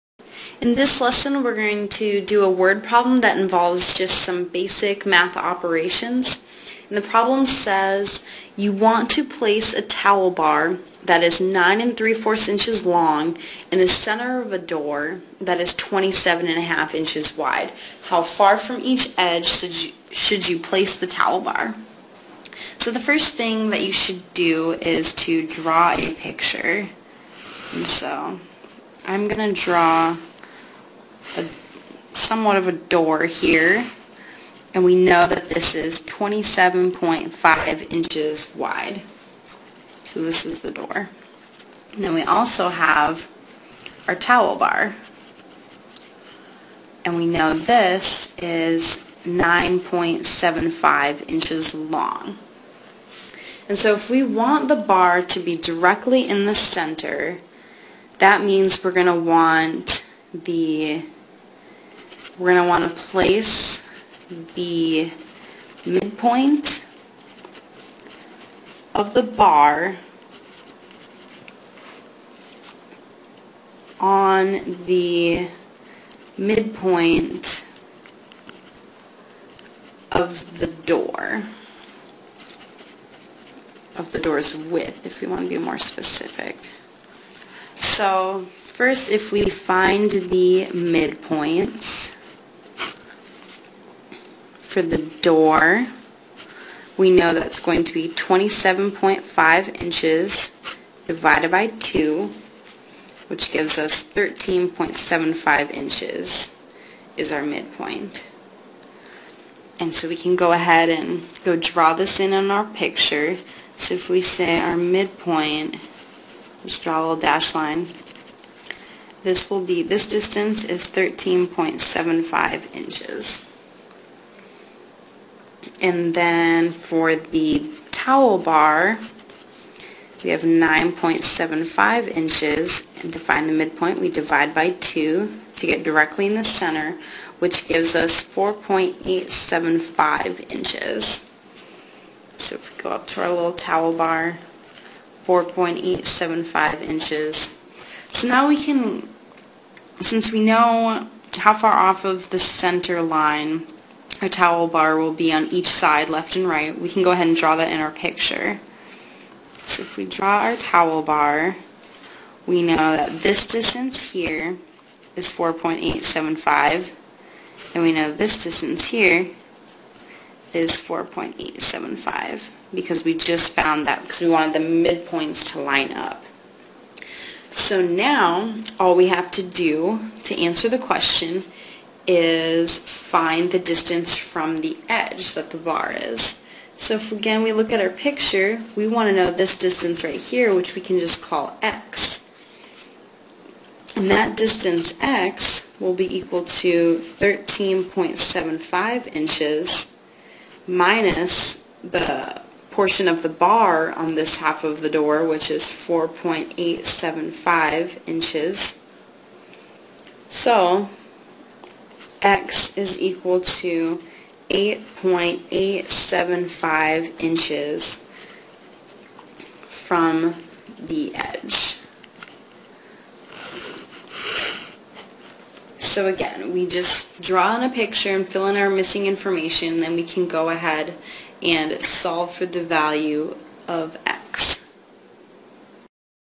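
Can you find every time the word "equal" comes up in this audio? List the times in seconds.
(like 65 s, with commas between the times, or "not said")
196 s, 213 s.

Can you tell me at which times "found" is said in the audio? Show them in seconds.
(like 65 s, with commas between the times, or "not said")
173 s.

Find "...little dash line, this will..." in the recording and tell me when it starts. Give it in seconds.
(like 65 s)
117 s.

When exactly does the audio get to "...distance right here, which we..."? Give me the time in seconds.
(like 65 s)
189 s.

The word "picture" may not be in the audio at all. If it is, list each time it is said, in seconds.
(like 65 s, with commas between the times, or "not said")
26 s, 112 s, 157 s, 187 s, 227 s.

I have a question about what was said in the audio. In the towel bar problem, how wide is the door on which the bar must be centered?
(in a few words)
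27 1/2 inches.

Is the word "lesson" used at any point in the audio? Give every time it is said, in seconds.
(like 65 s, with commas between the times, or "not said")
1 s.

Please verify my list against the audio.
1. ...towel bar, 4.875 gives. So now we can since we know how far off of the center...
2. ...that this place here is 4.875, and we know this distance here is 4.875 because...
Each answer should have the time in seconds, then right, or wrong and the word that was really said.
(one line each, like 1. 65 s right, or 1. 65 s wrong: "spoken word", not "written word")
1. 143 s wrong: "inches", not "gives"
2. 162 s wrong: "distance", not "place".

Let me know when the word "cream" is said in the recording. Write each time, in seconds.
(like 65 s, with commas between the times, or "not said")
not said.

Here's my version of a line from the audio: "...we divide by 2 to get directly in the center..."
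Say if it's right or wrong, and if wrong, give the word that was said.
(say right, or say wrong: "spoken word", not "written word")
right.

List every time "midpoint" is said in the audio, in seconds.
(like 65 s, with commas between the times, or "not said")
65 s, 76 s, 90 s, 107 s, 114 s, 133 s, 174 s.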